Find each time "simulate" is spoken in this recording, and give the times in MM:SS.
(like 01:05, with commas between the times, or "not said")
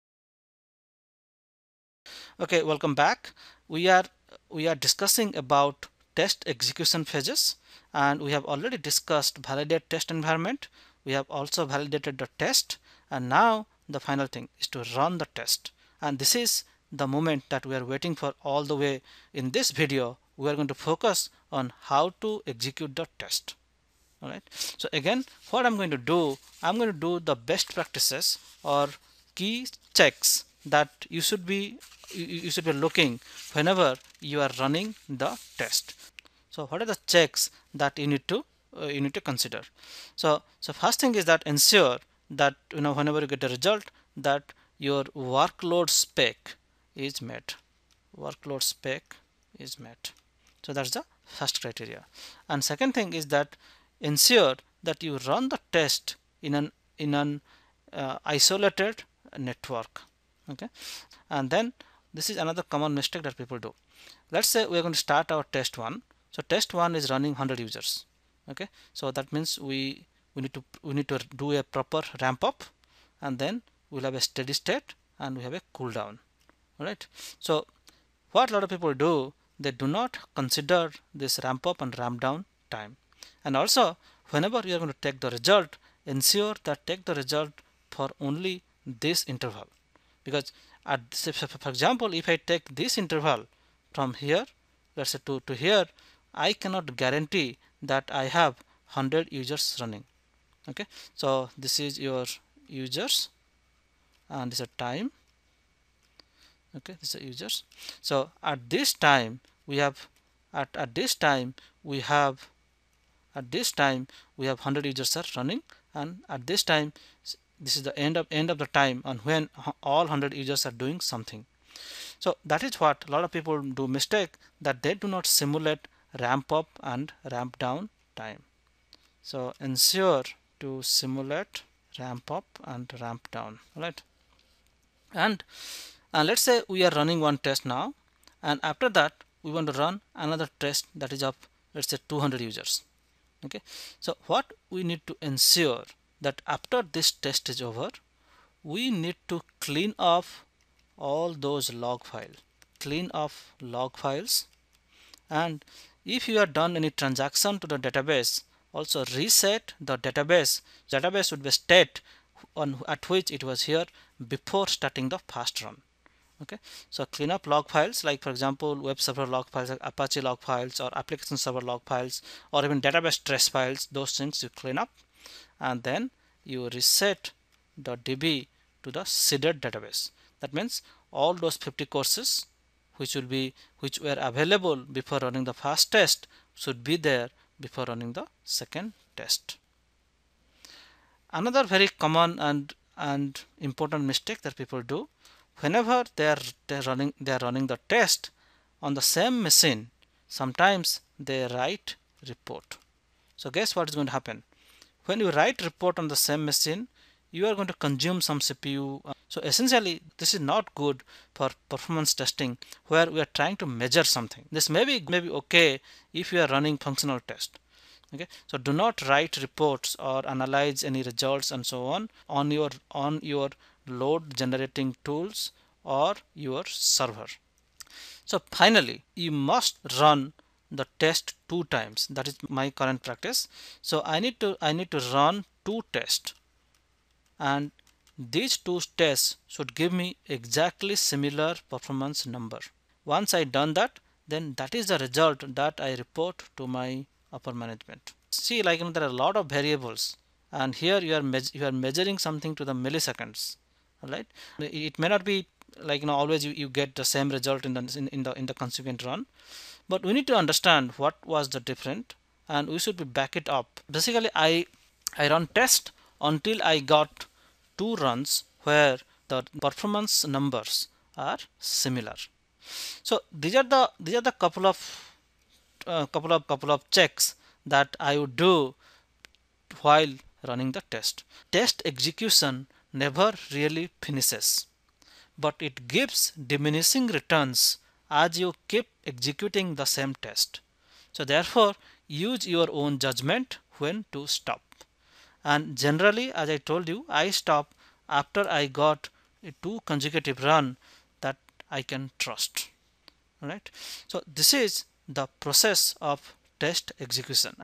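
02:05, 02:10.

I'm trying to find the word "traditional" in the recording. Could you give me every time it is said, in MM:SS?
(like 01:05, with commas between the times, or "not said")
not said.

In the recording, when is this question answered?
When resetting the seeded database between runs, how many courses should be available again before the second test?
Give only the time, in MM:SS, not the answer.
03:01.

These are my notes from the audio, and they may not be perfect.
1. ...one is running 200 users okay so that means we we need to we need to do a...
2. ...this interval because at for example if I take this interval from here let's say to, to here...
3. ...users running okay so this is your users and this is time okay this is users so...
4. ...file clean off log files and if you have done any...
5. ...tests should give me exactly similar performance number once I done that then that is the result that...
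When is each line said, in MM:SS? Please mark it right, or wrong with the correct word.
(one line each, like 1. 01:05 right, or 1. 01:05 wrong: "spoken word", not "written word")
1. 01:06 wrong: "100", not "200"
2. 01:29 right
3. 01:39 right
4. 02:32 right
5. 03:58 right.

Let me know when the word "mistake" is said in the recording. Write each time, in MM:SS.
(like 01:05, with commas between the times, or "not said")
01:02, 02:03, 03:14.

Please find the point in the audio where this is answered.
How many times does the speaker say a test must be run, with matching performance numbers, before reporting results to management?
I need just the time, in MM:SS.
03:51.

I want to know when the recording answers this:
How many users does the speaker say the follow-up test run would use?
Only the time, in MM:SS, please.
02:22.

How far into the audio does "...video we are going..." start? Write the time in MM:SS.
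00:19.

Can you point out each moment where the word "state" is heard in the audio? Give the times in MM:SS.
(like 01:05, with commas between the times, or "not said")
01:14, 02:41.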